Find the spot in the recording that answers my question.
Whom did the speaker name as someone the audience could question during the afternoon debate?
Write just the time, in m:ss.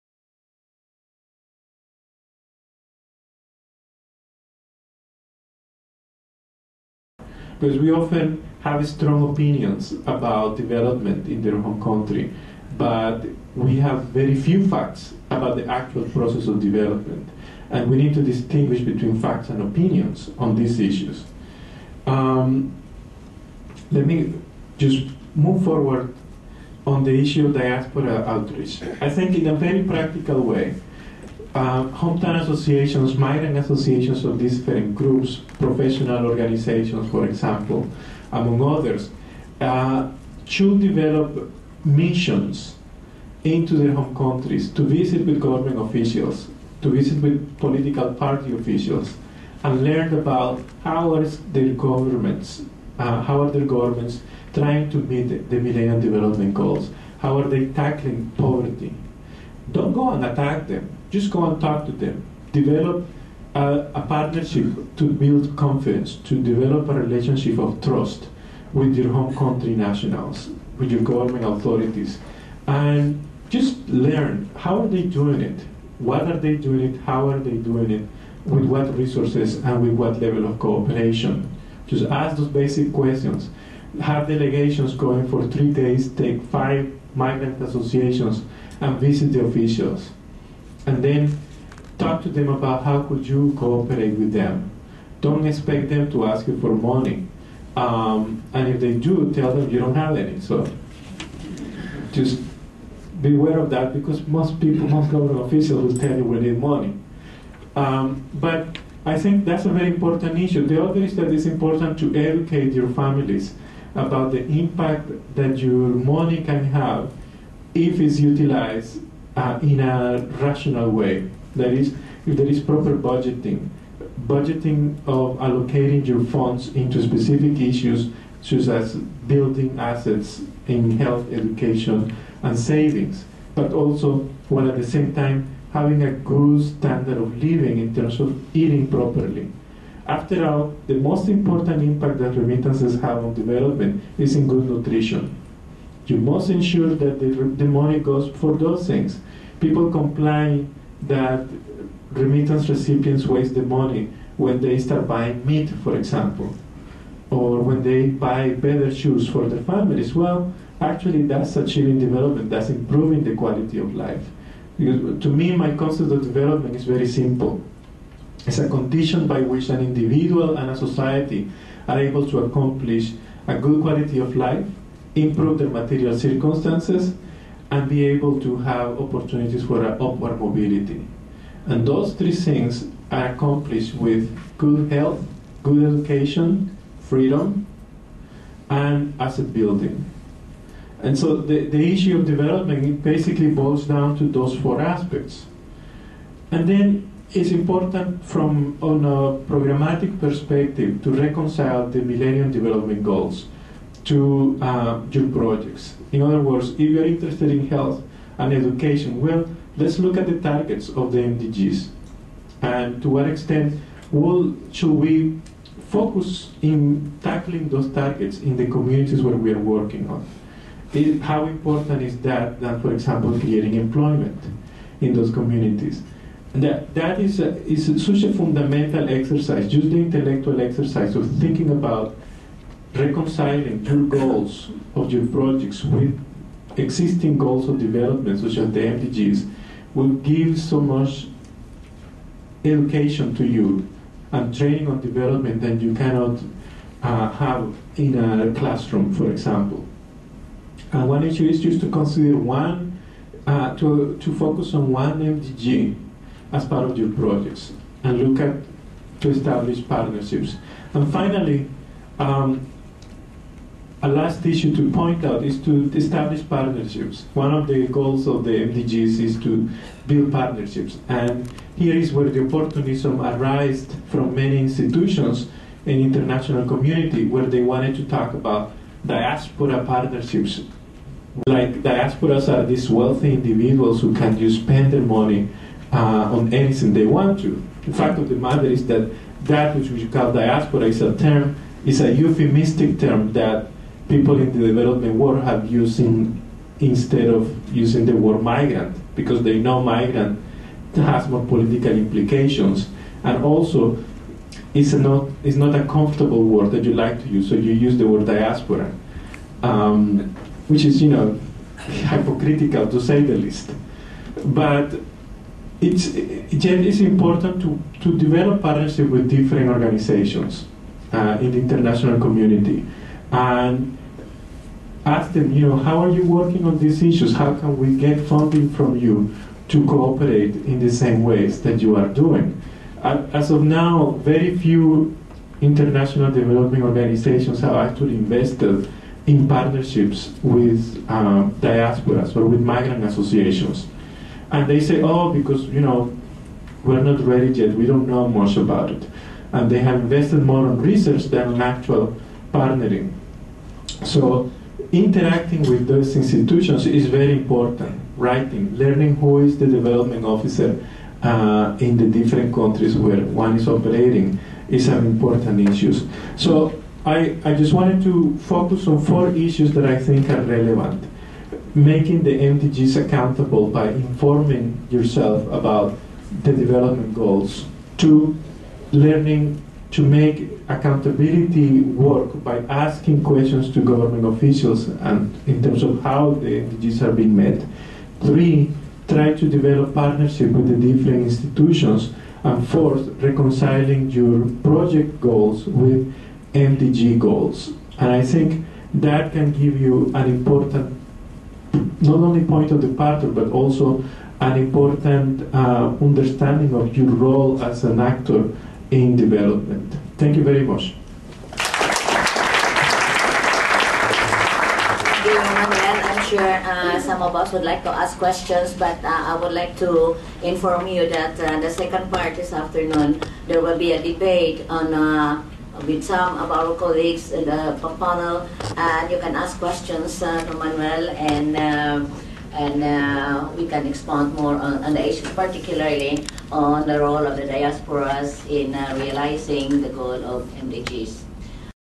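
7:10.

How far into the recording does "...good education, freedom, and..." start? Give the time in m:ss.
3:05.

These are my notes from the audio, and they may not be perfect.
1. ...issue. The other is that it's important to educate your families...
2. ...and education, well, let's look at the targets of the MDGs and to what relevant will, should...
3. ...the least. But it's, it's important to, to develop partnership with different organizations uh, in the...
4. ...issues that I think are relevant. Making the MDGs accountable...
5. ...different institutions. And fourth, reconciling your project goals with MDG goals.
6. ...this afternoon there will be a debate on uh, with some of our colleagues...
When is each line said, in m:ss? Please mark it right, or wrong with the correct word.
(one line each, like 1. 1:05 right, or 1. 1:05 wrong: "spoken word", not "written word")
1. 1:50 right
2. 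3:28 wrong: "extent", not "relevant"
3. 5:13 right
4. 6:09 right
5. 6:30 right
6. 7:02 right.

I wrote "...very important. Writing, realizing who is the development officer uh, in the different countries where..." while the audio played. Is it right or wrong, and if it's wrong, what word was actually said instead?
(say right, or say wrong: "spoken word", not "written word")
wrong: "learning", not "realizing".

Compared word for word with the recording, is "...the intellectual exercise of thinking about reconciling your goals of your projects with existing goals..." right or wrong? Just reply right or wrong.
right.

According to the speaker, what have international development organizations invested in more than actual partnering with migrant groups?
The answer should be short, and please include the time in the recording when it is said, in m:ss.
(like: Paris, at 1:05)
research, at 5:50.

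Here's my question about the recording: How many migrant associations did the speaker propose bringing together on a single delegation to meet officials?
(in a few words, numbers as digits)
5.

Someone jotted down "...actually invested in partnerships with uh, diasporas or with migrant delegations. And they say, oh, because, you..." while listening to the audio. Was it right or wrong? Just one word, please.
wrong.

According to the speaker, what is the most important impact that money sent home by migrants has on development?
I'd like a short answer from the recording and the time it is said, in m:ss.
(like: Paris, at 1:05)
good nutrition, at 2:24.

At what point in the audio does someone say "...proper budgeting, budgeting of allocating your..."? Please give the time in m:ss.
2:02.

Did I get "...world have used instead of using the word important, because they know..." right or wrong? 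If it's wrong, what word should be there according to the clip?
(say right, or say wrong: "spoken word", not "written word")
wrong: "migrant", not "important".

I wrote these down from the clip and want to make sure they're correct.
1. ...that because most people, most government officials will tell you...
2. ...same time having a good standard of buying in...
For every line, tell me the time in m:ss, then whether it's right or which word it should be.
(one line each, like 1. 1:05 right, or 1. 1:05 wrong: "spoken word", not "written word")
1. 1:43 right
2. 2:14 wrong: "living", not "buying".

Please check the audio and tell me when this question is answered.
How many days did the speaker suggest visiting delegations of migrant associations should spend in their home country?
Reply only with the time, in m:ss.
1:25.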